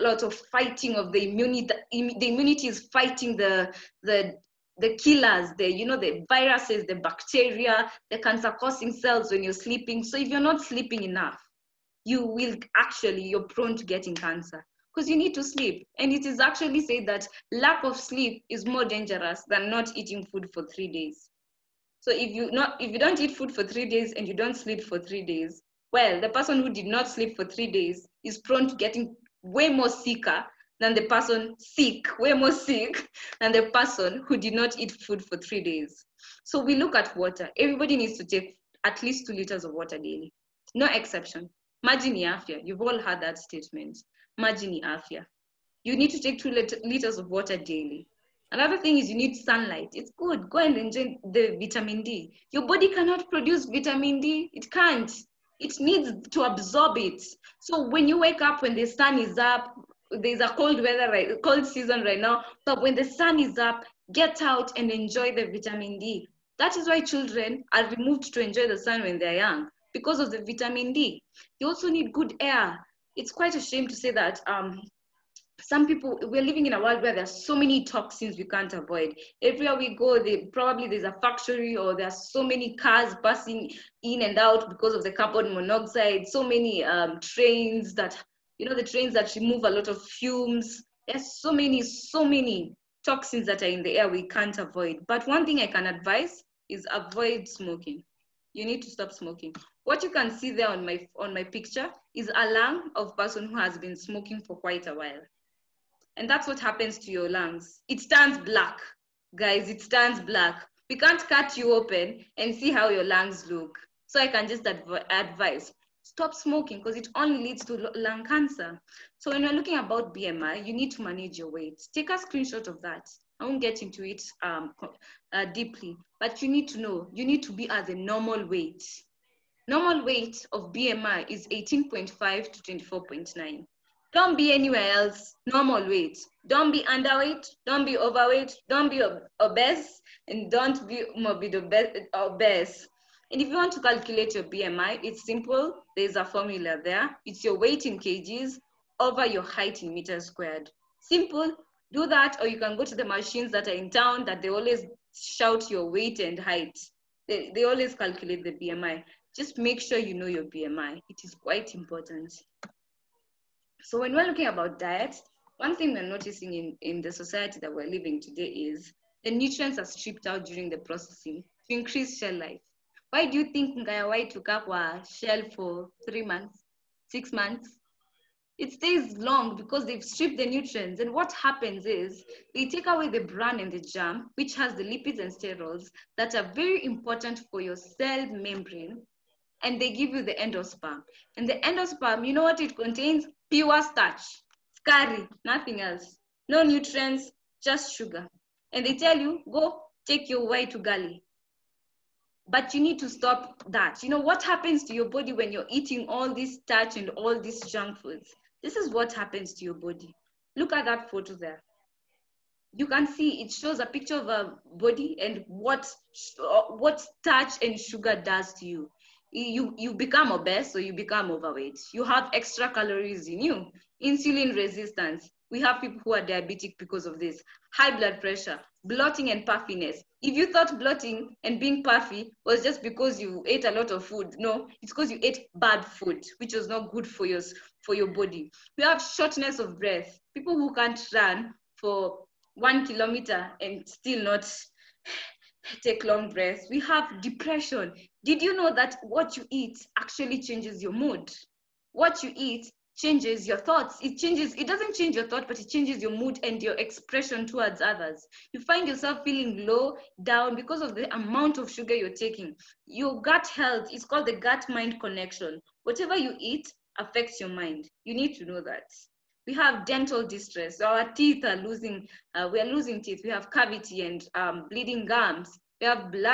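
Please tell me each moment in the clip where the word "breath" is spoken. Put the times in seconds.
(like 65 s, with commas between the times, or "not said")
239 s, 246 s.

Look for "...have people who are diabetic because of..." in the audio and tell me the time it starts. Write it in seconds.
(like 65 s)
225 s.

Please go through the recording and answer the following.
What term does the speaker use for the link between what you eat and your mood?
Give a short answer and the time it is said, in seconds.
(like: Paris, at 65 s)
gut mind connection, at 264 s.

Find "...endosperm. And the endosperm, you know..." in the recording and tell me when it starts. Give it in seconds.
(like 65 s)
190 s.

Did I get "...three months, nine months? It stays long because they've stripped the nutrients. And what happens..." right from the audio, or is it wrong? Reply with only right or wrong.
wrong.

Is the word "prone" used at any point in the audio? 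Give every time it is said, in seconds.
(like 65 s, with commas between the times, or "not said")
13 s, 28 s.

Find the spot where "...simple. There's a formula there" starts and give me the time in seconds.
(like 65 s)
145 s.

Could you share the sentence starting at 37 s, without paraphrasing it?
Everybody needs to take at least two liters of water daily.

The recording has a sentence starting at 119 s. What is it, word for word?
So when you're looking about BMI, you need to manage your weight.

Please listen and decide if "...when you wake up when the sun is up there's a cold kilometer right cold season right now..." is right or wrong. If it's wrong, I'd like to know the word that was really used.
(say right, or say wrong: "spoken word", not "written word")
wrong: "weather", not "kilometer".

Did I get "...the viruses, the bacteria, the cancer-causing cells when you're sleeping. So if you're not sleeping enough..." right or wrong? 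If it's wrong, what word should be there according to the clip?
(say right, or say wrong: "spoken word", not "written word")
right.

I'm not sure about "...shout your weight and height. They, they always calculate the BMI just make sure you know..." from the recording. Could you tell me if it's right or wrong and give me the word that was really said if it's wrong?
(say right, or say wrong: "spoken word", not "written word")
right.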